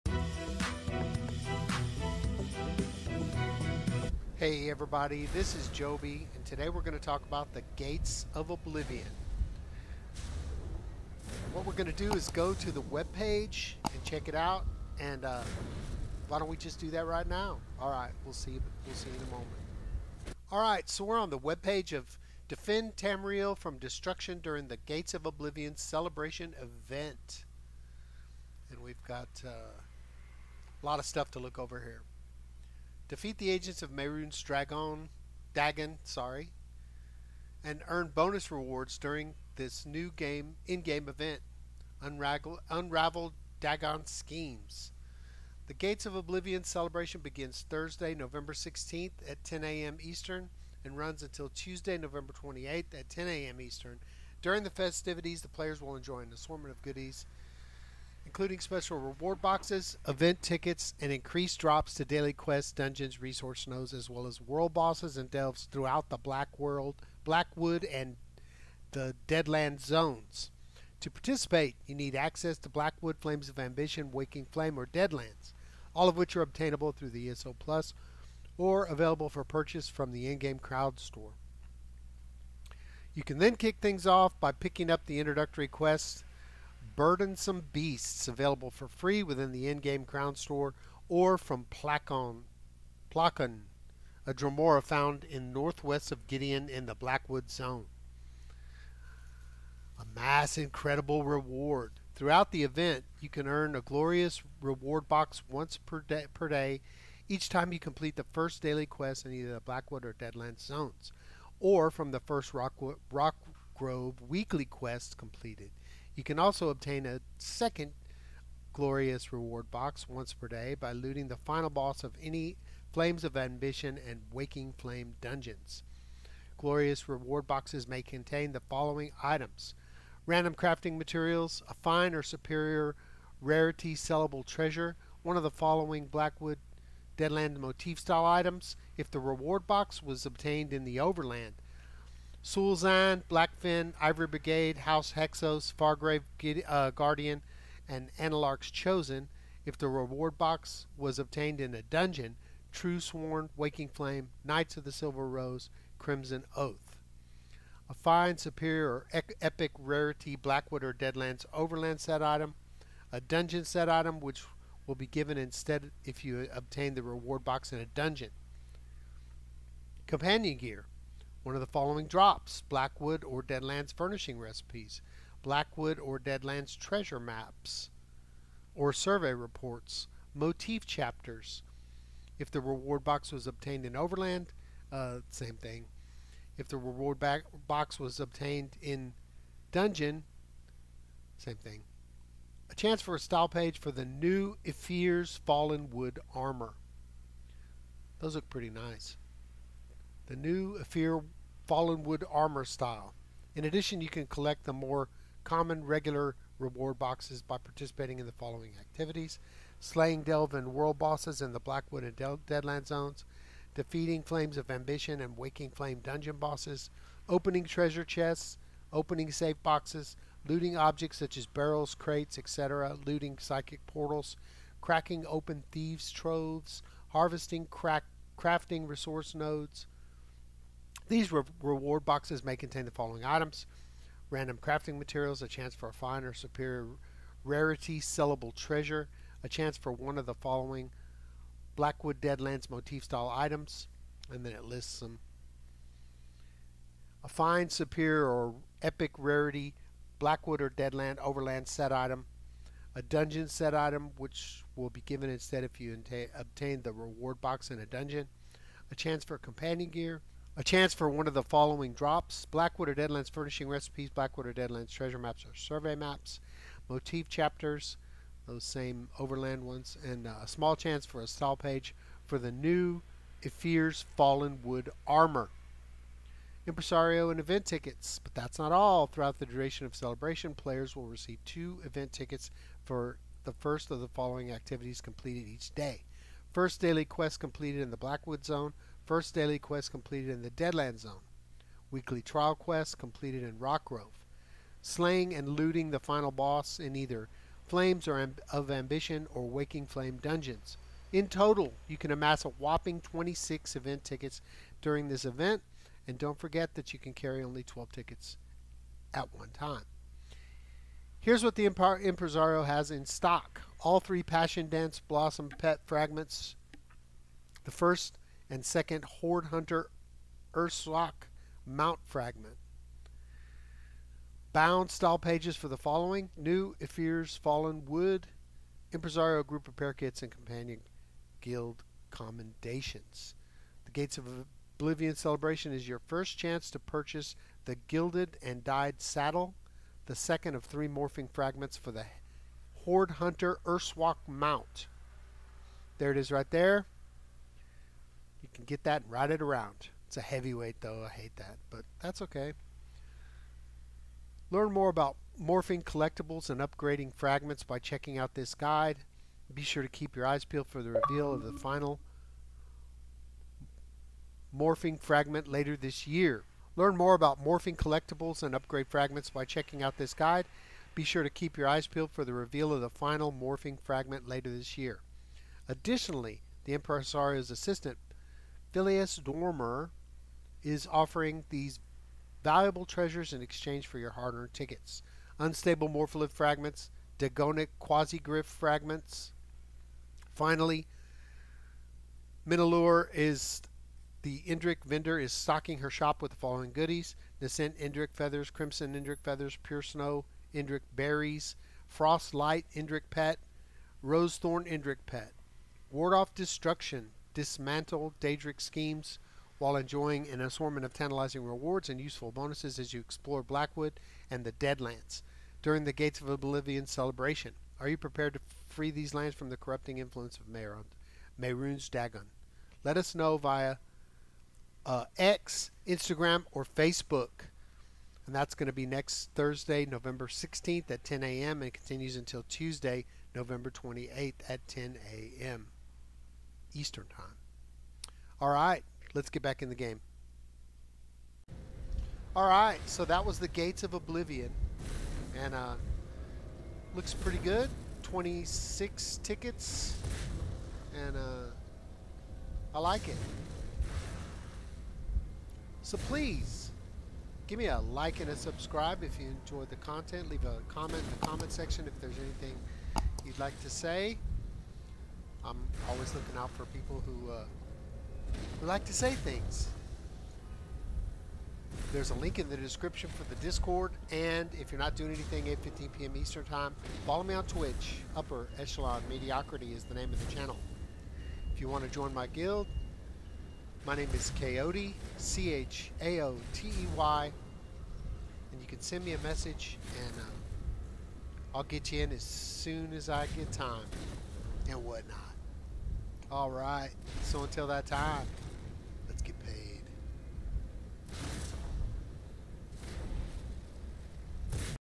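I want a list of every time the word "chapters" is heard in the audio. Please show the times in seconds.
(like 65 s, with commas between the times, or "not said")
180 s, 267 s.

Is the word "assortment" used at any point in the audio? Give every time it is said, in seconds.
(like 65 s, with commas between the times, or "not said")
56 s, 410 s.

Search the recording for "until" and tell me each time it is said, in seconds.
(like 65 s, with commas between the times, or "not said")
51 s, 432 s, 497 s.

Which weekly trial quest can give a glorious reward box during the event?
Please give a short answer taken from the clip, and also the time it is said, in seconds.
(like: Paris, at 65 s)
Rockgrove, at 112 s.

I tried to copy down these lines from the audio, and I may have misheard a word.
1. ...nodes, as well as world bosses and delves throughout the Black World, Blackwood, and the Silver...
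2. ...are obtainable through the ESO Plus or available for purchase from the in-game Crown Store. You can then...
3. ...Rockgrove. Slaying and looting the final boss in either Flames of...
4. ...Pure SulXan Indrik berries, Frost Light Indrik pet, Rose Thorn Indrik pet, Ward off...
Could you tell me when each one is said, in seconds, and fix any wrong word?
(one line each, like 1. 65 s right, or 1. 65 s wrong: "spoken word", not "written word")
1. 63 s wrong: "Deadland", not "Silver"
2. 76 s right
3. 293 s right
4. 399 s wrong: "Snow", not "SulXan".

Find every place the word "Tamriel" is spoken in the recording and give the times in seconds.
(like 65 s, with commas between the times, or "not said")
22 s.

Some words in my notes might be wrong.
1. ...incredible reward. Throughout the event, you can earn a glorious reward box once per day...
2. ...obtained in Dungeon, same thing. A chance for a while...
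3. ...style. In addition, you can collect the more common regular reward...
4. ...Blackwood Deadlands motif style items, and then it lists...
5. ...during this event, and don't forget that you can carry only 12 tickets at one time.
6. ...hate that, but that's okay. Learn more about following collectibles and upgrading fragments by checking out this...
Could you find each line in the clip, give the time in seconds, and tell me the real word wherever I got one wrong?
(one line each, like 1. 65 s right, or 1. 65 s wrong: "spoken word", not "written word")
1. 100 s right
2. 188 s wrong: "style", not "while"
3. 202 s right
4. 241 s right
5. 304 s right
6. 351 s wrong: "morphing", not "following".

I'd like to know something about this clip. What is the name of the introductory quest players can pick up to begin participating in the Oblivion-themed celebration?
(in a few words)
Burdensome Beasts.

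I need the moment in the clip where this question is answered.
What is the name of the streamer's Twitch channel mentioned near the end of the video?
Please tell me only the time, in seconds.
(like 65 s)
478 s.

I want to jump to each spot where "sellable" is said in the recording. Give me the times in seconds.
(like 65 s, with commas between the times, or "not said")
133 s, 237 s.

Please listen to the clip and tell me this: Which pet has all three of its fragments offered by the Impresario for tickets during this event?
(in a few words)
Passion Dance Blossom.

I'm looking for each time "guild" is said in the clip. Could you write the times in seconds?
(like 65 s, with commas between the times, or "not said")
331 s, 482 s.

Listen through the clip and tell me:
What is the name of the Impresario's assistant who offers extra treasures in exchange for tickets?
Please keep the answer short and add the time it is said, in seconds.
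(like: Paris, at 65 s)
Philius Dormier, at 378 s.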